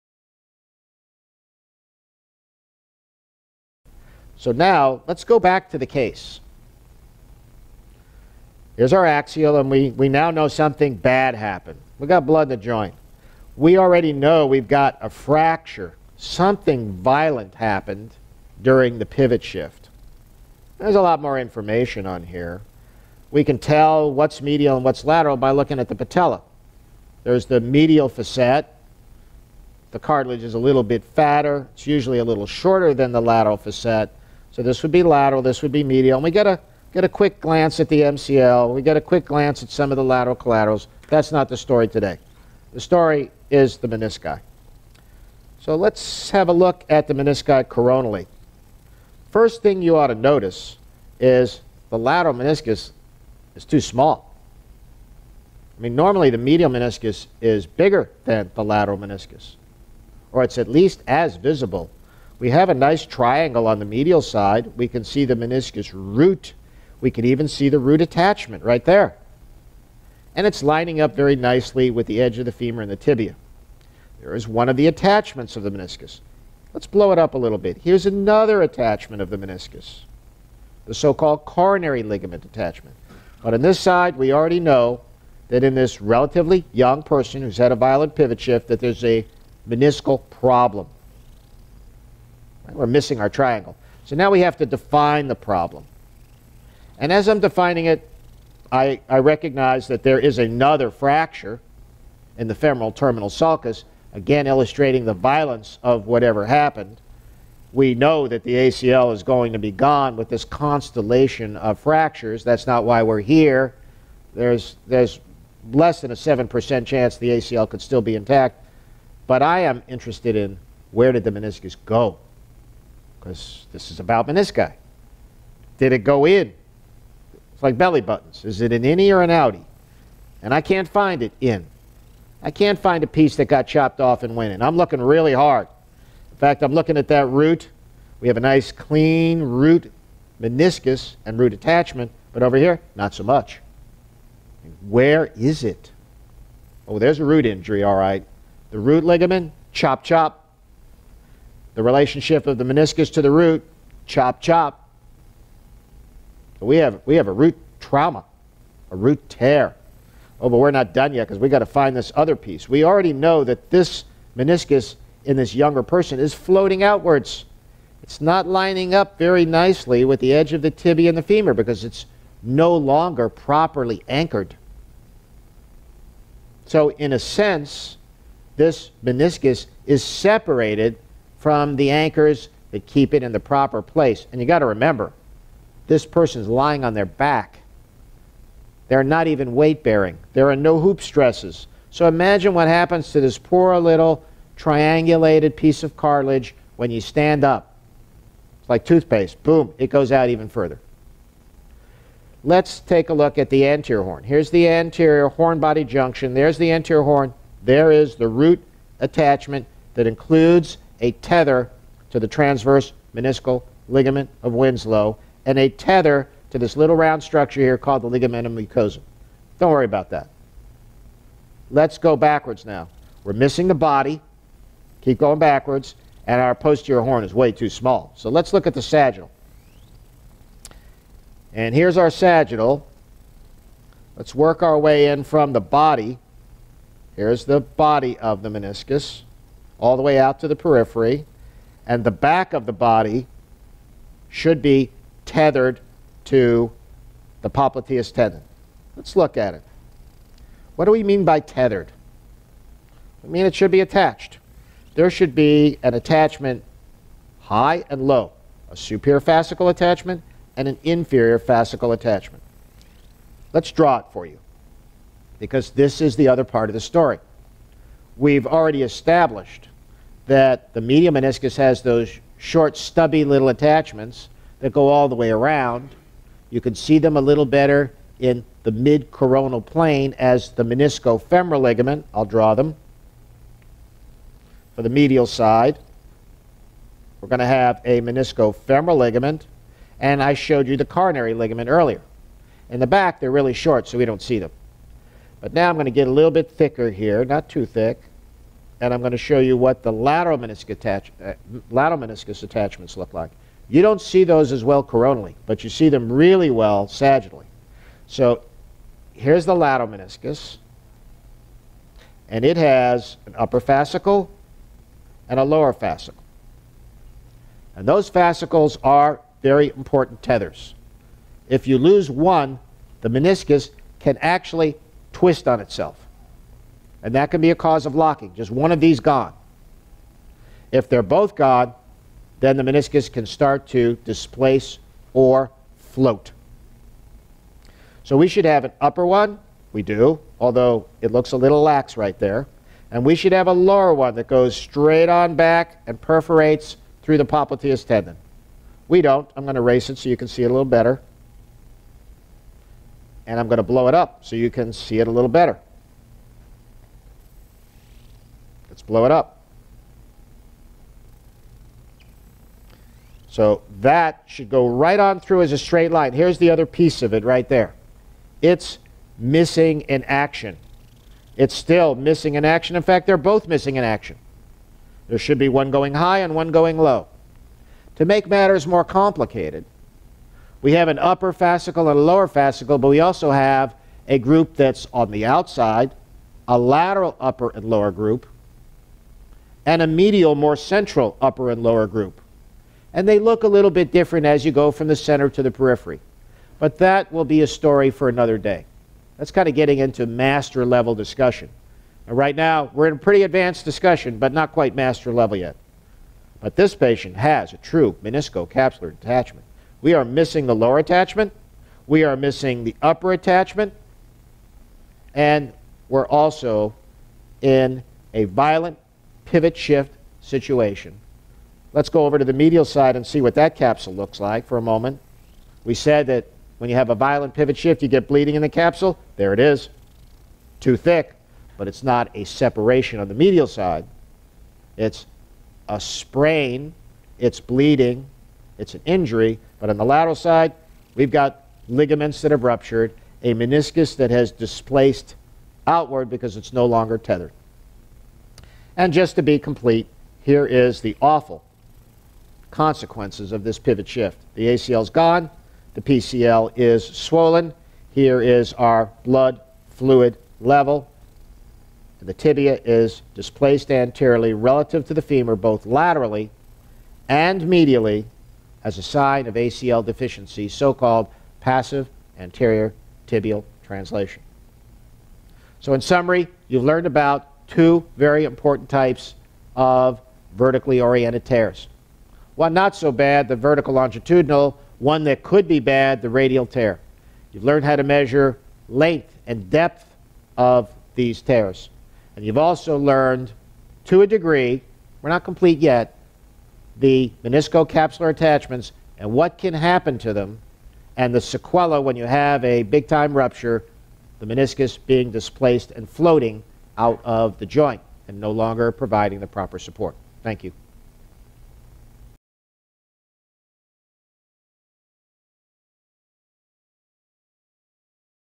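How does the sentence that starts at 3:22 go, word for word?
Let's take a look at the anterior horn.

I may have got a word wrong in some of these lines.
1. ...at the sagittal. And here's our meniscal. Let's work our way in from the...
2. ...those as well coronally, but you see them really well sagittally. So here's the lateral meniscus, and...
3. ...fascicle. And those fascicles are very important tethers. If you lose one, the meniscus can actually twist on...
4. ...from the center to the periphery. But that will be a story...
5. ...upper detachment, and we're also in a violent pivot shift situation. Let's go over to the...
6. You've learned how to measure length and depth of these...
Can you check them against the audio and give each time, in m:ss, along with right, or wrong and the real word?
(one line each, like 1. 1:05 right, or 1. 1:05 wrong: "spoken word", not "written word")
1. 3:48 wrong: "sagittal", not "meniscal"
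2. 5:04 right
3. 5:15 right
4. 6:34 right
5. 6:52 wrong: "attachment", not "detachment"
6. 8:07 right.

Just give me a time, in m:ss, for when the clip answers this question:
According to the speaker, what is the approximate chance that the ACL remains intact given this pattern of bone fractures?
1:55.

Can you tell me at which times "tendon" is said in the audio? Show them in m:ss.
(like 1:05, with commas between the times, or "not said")
4:08, 5:47.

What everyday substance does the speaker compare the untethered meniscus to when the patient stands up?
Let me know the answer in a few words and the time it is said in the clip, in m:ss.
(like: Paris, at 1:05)
toothpaste, at 3:18.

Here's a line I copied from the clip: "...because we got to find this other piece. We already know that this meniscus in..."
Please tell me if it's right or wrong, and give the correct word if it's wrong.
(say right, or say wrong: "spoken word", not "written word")
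right.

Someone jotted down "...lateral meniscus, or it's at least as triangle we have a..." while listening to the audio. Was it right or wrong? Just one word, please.
wrong.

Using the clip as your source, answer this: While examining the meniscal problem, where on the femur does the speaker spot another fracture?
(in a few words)
femoral terminal sulcus.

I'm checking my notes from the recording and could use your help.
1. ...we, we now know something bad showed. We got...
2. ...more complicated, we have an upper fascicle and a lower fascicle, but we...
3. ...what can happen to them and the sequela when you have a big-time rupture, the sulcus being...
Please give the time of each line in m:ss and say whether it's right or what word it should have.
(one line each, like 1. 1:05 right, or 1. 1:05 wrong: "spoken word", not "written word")
1. 0:09 wrong: "happened", not "showed"
2. 6:18 right
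3. 8:19 wrong: "meniscus", not "sulcus".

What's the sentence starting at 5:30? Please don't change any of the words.
If they're both gone, then the meniscus can start to displace or float.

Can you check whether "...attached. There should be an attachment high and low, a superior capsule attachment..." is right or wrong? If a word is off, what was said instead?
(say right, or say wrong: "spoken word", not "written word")
wrong: "fascicle", not "capsule".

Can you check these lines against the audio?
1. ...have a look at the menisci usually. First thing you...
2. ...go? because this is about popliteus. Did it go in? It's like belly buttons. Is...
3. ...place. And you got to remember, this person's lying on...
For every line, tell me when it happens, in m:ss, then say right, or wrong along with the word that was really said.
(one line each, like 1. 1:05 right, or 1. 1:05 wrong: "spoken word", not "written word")
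1. 0:46 wrong: "coronally", not "usually"
2. 2:01 wrong: "meniscus", not "popliteus"
3. 3:03 right.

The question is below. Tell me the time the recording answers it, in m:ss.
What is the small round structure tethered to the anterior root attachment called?
3:38.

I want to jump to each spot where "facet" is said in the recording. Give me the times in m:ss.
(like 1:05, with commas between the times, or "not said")
0:28, 0:33.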